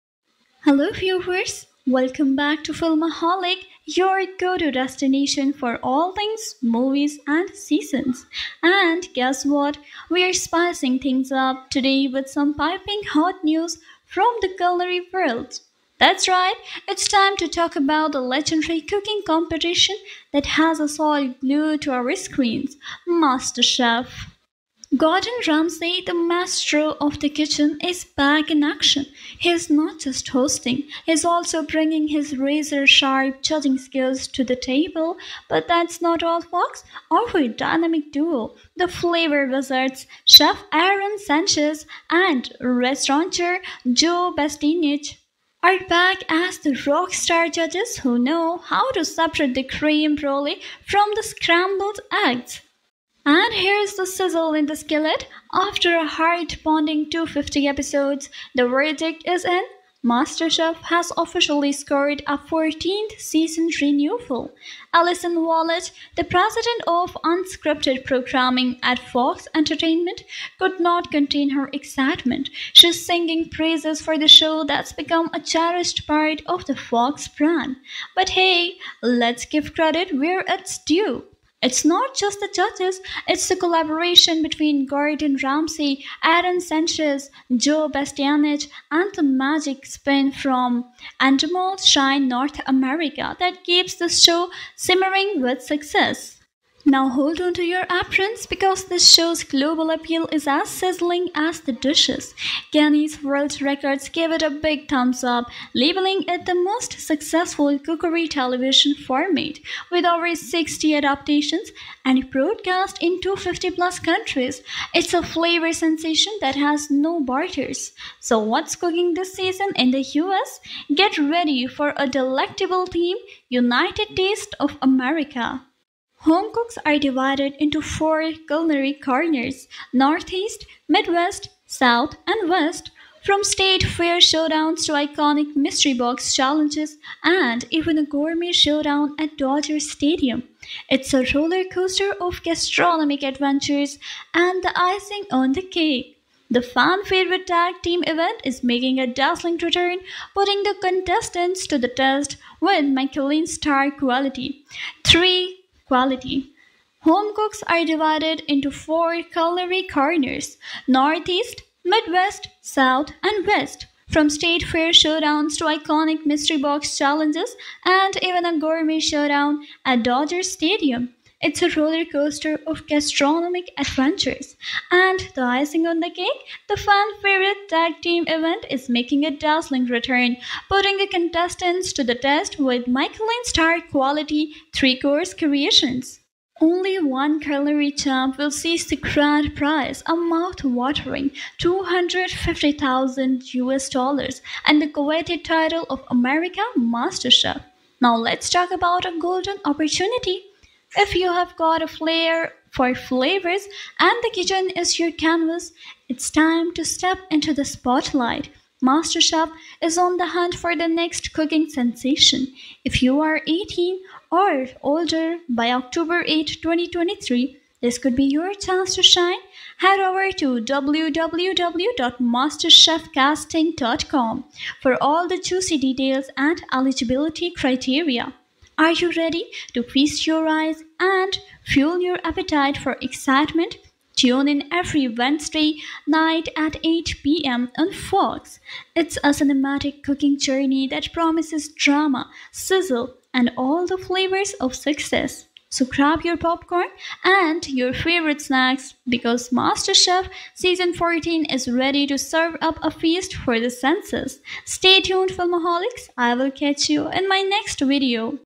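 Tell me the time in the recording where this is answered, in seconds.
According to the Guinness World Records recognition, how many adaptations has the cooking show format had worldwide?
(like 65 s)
110 s.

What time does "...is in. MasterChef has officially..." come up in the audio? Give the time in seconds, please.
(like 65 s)
59 s.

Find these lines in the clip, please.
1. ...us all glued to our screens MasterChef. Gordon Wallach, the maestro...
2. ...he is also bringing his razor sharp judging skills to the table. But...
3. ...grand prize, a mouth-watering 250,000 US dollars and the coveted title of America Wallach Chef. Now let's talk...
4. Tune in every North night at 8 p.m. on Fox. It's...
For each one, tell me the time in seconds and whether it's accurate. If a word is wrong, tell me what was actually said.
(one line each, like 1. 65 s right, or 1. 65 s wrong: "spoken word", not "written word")
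1. 20 s wrong: "Ramsay", not "Wallach"
2. 31 s right
3. 188 s wrong: "Master", not "Wallach"
4. 234 s wrong: "Wednesday", not "North".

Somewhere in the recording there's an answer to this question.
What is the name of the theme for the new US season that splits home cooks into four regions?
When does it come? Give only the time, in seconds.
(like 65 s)
123 s.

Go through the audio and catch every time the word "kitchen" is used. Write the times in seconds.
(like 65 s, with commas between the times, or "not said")
27 s, 204 s.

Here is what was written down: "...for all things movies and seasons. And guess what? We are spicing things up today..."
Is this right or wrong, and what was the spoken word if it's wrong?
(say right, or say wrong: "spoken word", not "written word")
right.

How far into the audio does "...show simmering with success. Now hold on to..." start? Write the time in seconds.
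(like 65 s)
94 s.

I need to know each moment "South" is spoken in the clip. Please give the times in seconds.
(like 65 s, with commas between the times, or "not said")
131 s, 162 s.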